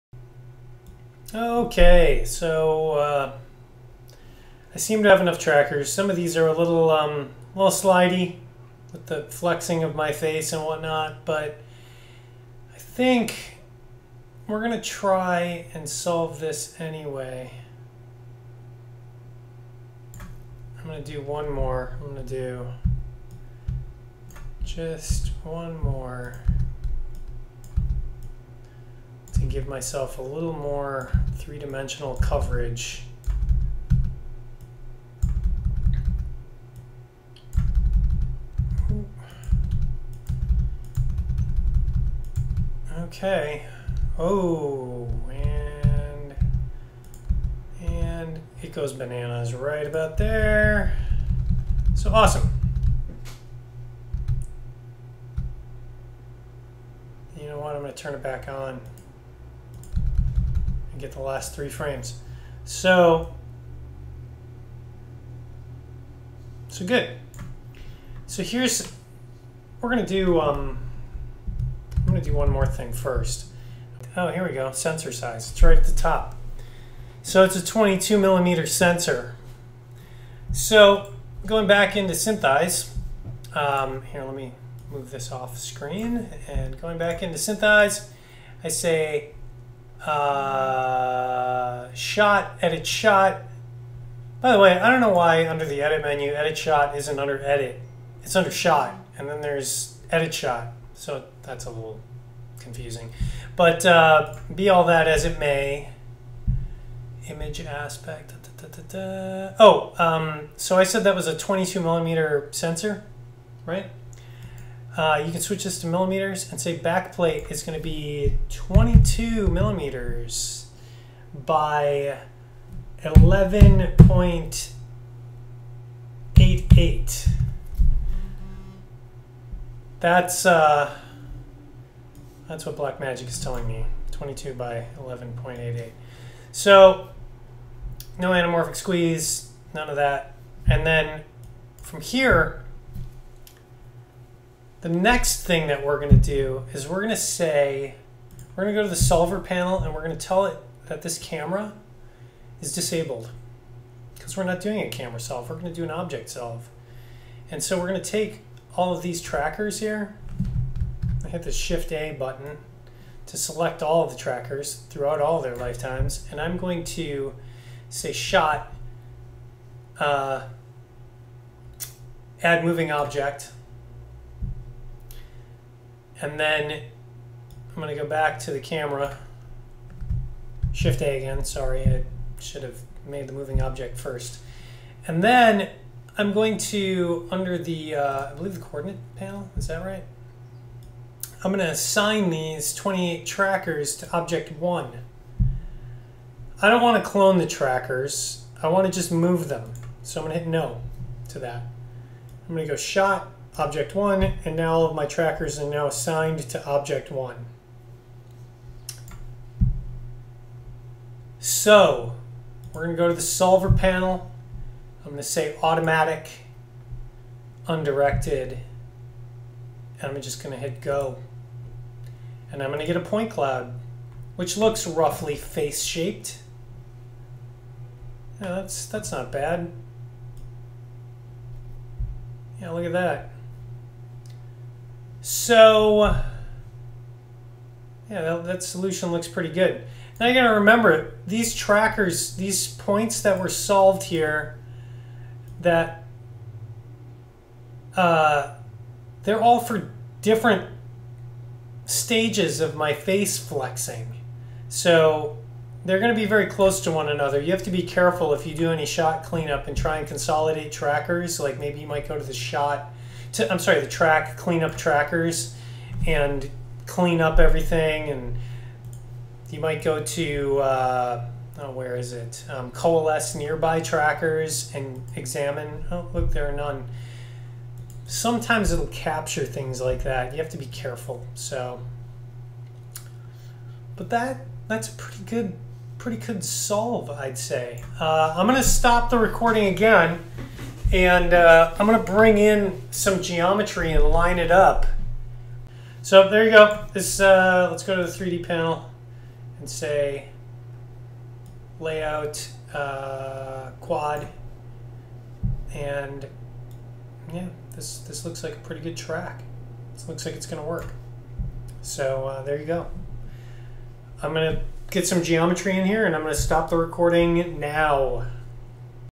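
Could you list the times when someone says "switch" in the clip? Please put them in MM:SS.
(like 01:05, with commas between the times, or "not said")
01:55.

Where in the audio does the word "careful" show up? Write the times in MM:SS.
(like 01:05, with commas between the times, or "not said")
04:17, 04:40.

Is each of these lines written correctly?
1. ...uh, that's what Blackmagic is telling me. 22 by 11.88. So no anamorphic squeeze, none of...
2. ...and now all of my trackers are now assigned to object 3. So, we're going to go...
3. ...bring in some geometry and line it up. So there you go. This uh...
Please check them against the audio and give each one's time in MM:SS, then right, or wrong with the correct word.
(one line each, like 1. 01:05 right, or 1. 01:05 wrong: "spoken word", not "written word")
1. 02:10 right
2. 03:24 wrong: "1", not "3"
3. 04:52 right.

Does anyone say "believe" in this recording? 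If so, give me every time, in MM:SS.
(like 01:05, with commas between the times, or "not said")
03:08.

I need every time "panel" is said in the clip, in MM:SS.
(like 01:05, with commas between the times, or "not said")
02:29, 03:09, 03:33, 04:58.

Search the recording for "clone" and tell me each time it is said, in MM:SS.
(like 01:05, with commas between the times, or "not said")
03:17.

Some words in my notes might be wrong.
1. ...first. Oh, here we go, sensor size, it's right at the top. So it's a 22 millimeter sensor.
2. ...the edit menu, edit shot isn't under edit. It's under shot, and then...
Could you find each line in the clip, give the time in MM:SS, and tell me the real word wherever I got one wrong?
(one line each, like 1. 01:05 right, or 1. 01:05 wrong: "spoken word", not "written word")
1. 01:12 right
2. 01:35 right.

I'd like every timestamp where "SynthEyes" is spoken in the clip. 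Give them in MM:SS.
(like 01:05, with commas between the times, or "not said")
01:22, 01:27.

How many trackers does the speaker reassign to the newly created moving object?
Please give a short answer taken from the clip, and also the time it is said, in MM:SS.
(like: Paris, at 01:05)
28, at 03:12.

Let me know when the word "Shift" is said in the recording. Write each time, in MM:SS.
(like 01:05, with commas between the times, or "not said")
02:41, 03:00.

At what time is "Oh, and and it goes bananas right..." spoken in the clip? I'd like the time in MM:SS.
00:44.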